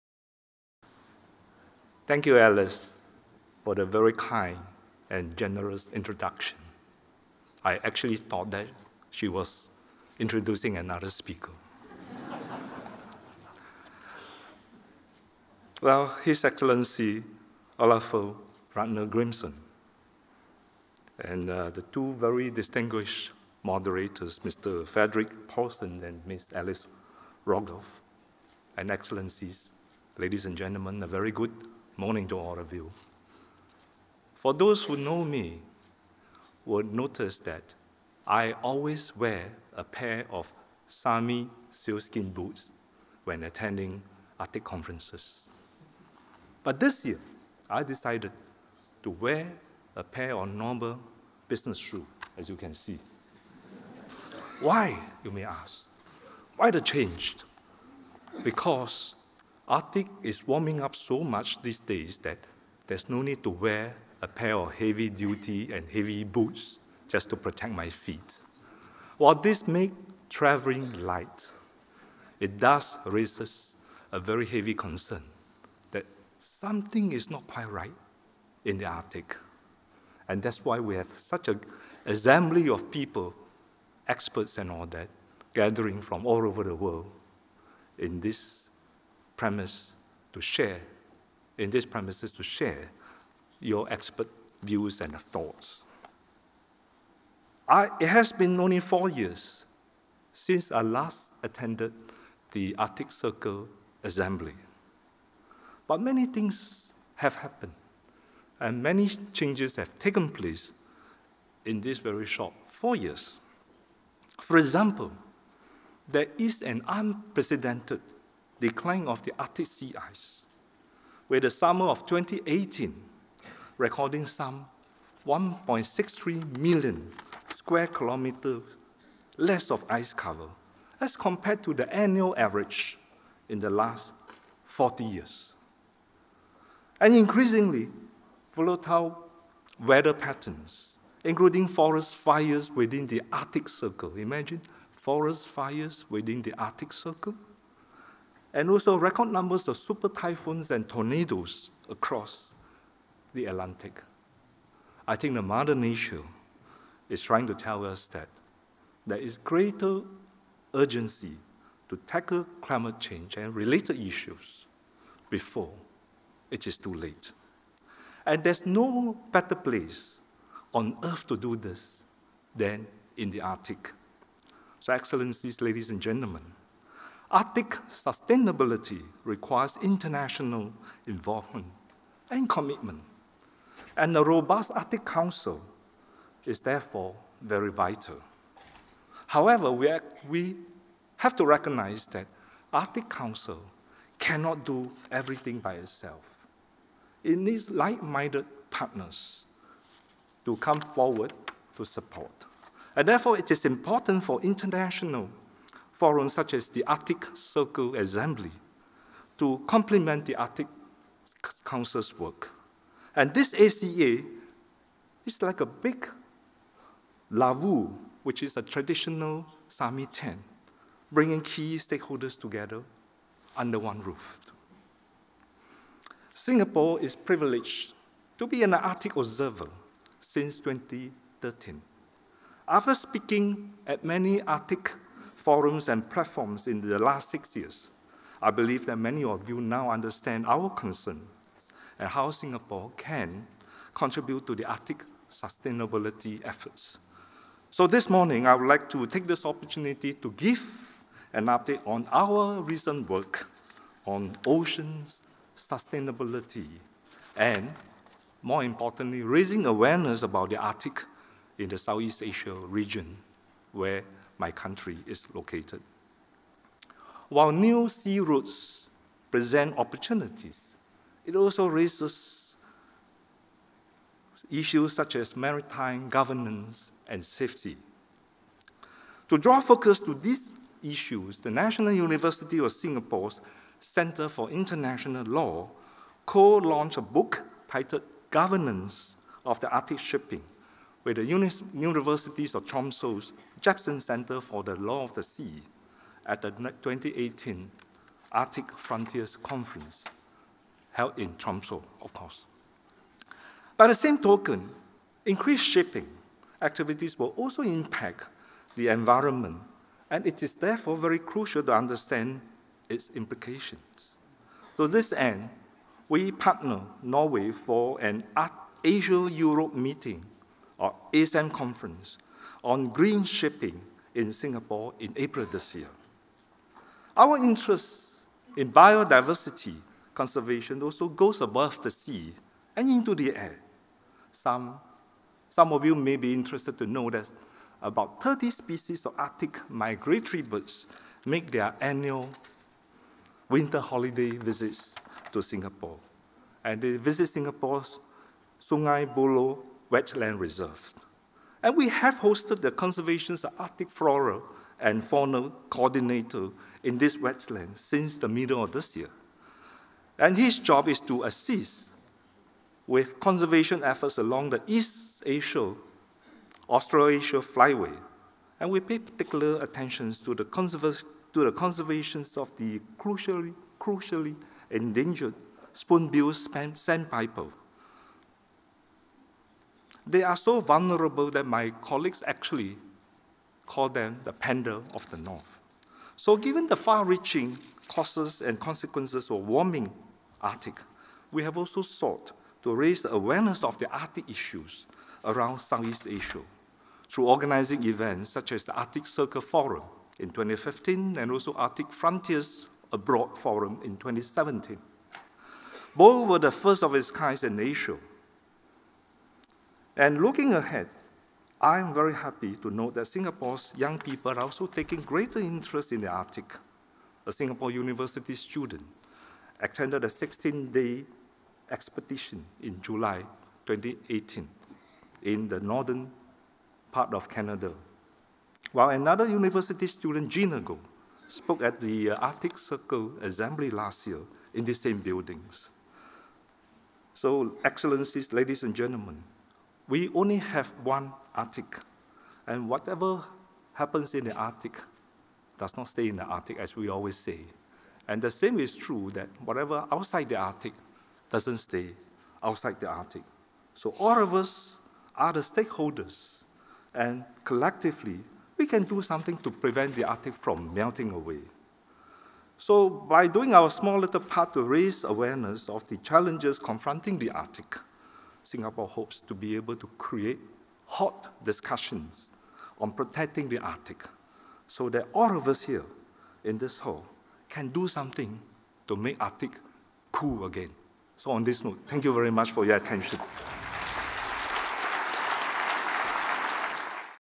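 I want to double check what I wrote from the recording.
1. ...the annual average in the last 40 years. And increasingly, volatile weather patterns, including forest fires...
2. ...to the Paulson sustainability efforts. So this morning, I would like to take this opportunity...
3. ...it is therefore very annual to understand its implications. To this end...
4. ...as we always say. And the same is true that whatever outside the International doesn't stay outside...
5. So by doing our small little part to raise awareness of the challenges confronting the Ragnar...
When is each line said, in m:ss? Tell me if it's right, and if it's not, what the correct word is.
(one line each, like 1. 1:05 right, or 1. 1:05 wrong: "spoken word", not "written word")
1. 2:11 right
2. 4:04 wrong: "Arctic", not "Paulson"
3. 5:10 wrong: "crucial", not "annual"
4. 7:26 wrong: "Arctic", not "International"
5. 7:42 wrong: "Arctic", not "Ragnar".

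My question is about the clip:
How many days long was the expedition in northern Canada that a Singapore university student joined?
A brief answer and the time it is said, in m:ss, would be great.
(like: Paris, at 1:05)
16, at 7:00.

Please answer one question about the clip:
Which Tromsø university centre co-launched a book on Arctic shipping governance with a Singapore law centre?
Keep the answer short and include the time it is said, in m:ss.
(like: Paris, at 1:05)
Jebsen Center for the Law of the Sea, at 4:53.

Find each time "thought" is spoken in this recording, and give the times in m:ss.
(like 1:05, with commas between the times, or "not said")
0:08, 1:35.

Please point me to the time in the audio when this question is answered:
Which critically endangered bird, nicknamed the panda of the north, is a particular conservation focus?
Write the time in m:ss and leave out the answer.
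6:15.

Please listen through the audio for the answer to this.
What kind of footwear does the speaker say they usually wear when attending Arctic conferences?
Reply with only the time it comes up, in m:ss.
0:40.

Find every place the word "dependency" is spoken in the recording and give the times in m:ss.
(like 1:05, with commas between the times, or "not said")
not said.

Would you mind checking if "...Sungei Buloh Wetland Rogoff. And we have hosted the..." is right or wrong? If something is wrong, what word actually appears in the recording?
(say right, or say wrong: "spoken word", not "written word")
wrong: "Reserve", not "Rogoff".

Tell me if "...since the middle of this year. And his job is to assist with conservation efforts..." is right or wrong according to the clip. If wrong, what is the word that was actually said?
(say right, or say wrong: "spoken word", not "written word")
right.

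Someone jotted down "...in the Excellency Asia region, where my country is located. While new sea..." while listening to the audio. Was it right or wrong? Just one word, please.
wrong.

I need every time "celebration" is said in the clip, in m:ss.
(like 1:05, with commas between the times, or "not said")
not said.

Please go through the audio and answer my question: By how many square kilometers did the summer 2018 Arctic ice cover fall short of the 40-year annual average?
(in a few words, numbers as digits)
1.63 million.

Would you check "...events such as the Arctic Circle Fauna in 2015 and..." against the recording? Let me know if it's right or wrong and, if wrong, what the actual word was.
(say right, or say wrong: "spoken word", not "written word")
wrong: "Forum", not "Fauna".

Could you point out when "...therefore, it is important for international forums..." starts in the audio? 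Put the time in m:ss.
3:23.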